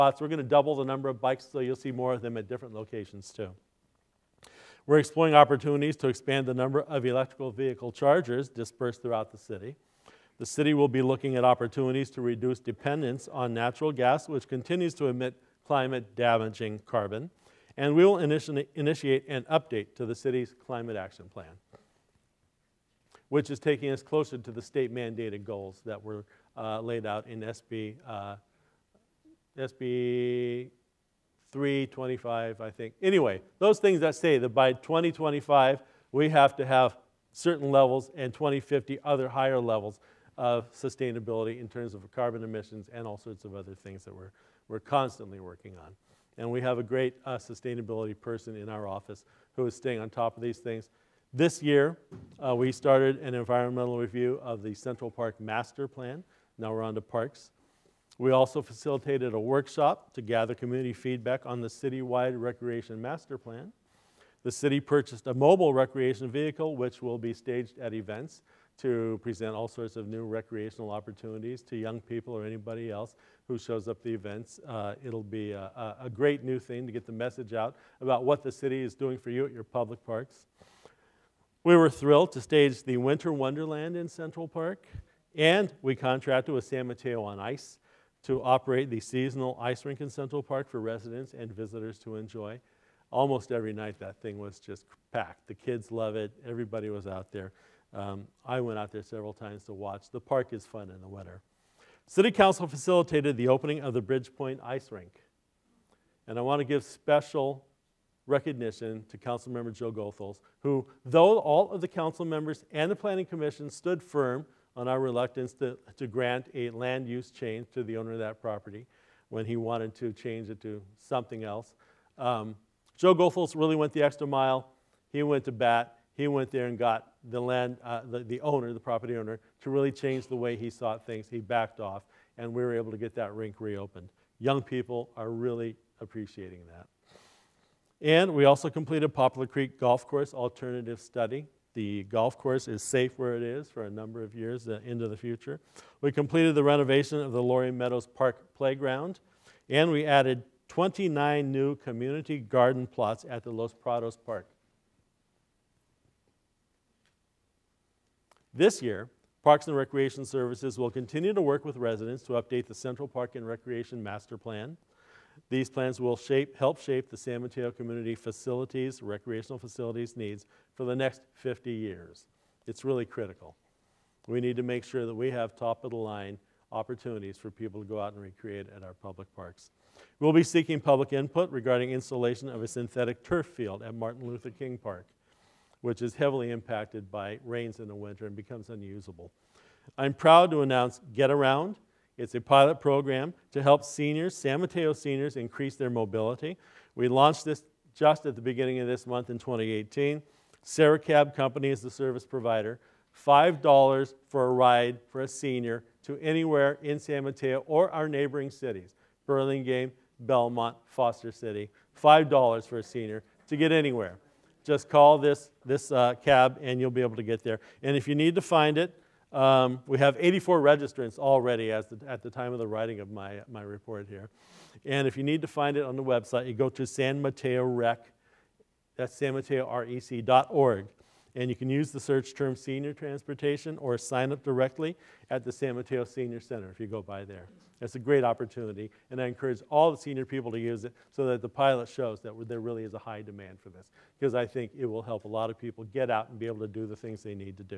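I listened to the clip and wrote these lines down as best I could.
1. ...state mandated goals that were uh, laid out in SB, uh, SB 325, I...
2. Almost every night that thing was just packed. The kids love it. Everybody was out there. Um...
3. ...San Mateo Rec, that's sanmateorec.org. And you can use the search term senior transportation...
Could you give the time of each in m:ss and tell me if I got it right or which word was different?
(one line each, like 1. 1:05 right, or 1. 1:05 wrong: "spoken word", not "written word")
1. 0:24 right
2. 1:33 right
3. 3:46 right.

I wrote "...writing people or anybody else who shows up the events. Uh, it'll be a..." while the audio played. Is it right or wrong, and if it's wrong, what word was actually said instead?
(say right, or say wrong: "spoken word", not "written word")
wrong: "young", not "writing".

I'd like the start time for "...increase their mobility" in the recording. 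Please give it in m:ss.
3:15.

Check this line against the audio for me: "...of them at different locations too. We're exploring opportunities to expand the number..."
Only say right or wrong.
right.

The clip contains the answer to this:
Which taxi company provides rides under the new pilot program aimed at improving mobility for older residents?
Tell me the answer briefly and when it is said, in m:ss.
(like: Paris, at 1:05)
Serra Cab Company, at 3:20.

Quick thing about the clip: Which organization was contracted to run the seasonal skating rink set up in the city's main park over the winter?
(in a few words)
San Mateo on Ice.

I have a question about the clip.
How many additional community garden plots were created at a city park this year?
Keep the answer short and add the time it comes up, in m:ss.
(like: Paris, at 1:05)
29, at 2:30.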